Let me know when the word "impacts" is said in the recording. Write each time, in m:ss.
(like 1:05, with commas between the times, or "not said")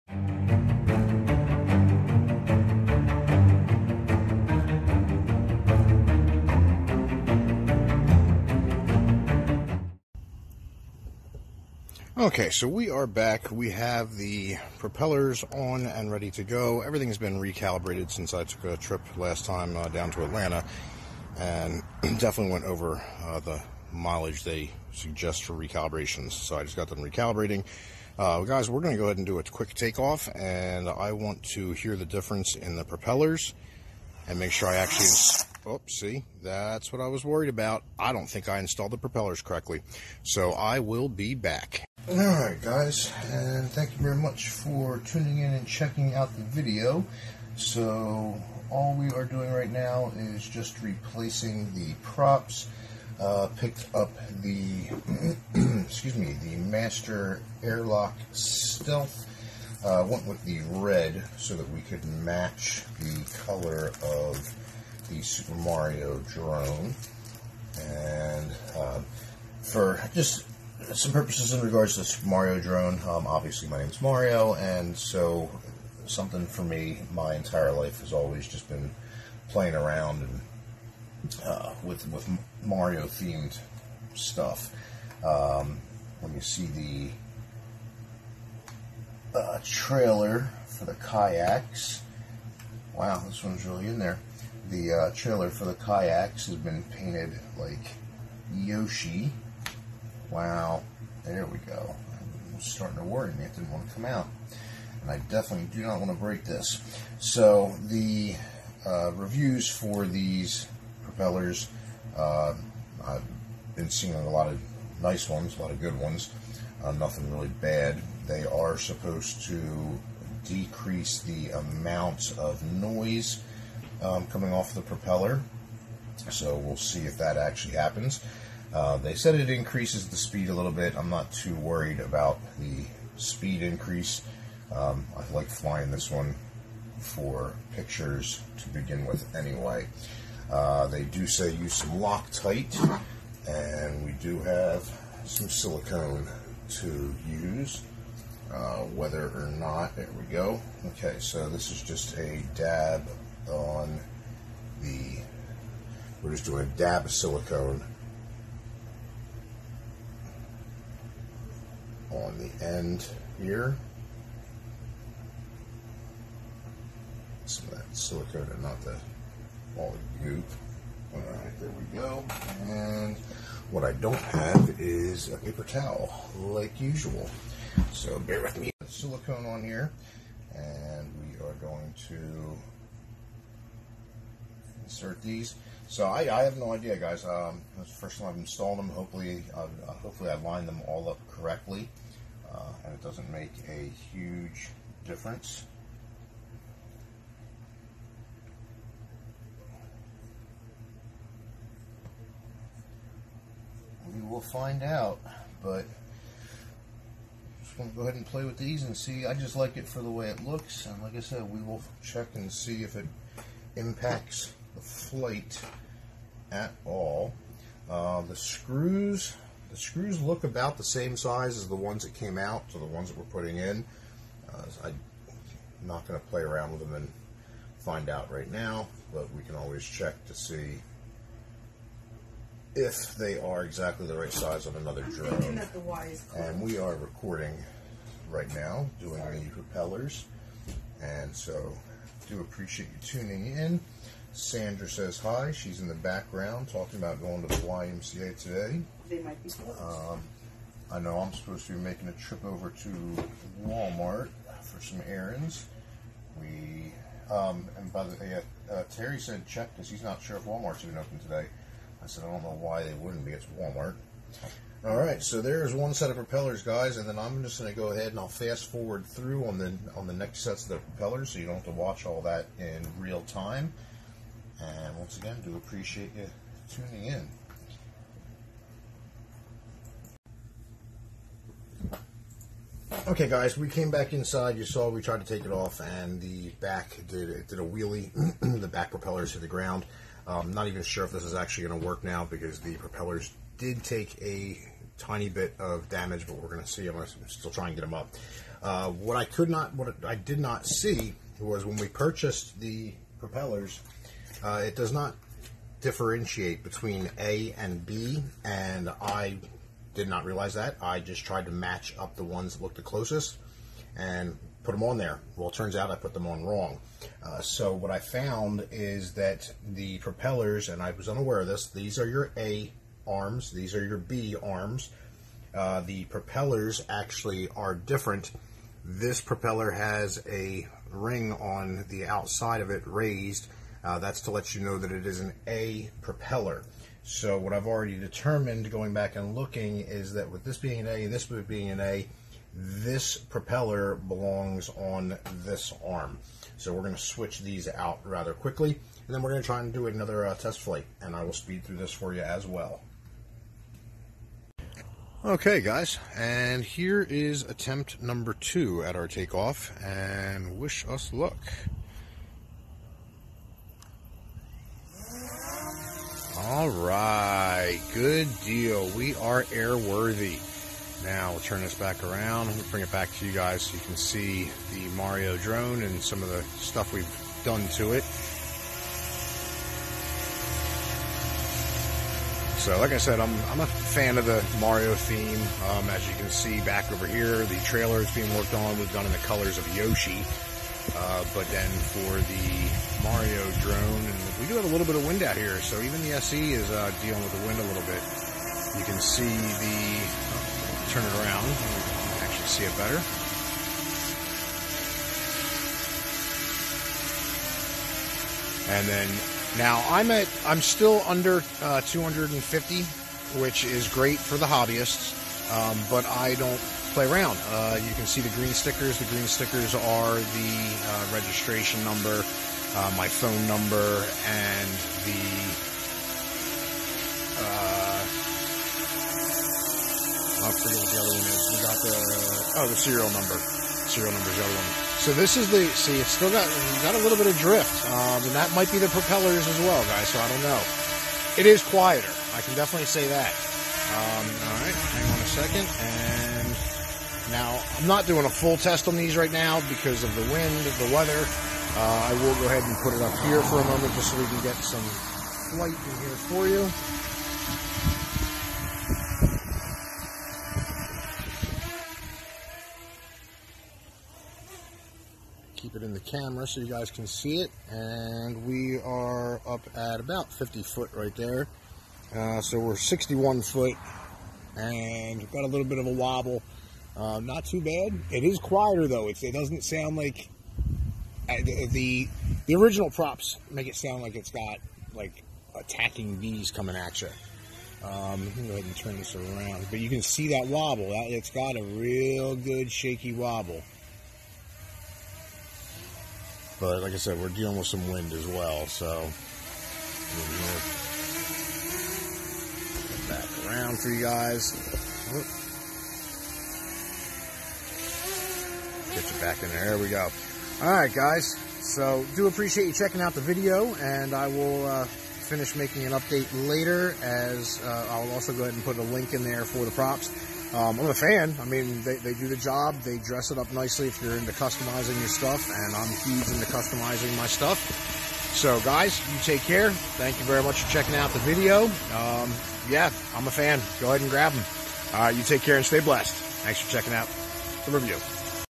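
3:33.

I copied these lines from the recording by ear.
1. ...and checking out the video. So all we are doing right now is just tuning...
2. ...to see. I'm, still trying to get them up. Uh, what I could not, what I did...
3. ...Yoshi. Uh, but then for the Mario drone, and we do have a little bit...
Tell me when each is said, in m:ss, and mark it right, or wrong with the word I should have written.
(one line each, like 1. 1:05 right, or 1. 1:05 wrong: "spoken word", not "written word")
1. 0:45 wrong: "replacing", not "tuning"
2. 4:56 right
3. 6:29 right.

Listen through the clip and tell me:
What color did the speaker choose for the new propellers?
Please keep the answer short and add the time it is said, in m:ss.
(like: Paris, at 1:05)
Red, at 1:00.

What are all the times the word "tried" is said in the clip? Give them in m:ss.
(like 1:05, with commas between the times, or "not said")
4:45, 5:11.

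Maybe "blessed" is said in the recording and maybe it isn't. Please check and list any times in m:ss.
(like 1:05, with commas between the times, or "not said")
8:55.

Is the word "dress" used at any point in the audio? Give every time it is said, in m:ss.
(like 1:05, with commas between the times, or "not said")
8:42.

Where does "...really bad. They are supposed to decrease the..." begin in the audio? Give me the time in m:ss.
1:57.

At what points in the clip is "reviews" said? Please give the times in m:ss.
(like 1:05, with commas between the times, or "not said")
1:49, 8:57.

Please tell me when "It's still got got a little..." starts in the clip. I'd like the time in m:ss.
7:15.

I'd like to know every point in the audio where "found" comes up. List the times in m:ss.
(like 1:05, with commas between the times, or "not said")
5:17.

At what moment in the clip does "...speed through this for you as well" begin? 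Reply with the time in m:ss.
5:51.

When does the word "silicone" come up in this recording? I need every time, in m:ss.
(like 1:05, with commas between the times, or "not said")
2:25, 2:37, 2:47, 2:58.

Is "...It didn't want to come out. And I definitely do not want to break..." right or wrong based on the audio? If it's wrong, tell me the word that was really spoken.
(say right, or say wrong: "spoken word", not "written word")
right.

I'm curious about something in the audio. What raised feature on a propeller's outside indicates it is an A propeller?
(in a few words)
A ring.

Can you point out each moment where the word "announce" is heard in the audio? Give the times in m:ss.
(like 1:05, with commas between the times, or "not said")
not said.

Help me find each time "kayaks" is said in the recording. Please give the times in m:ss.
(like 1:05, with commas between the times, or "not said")
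1:30, 1:35.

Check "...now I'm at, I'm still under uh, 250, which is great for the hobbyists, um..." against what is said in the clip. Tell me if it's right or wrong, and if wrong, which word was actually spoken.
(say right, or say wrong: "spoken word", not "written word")
right.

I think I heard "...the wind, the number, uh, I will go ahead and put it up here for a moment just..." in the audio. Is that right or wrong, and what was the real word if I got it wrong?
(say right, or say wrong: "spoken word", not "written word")
wrong: "weather", not "number".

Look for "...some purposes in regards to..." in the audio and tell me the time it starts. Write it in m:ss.
1:10.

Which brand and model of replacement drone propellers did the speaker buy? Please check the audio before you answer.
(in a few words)
Master Airlock Stealth.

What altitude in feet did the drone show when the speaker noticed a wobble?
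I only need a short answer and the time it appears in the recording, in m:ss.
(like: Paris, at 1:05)
61, at 7:52.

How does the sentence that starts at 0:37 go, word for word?
I don't think I installed the propellers correctly.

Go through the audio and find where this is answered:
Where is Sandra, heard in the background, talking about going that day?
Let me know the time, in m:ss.
4:07.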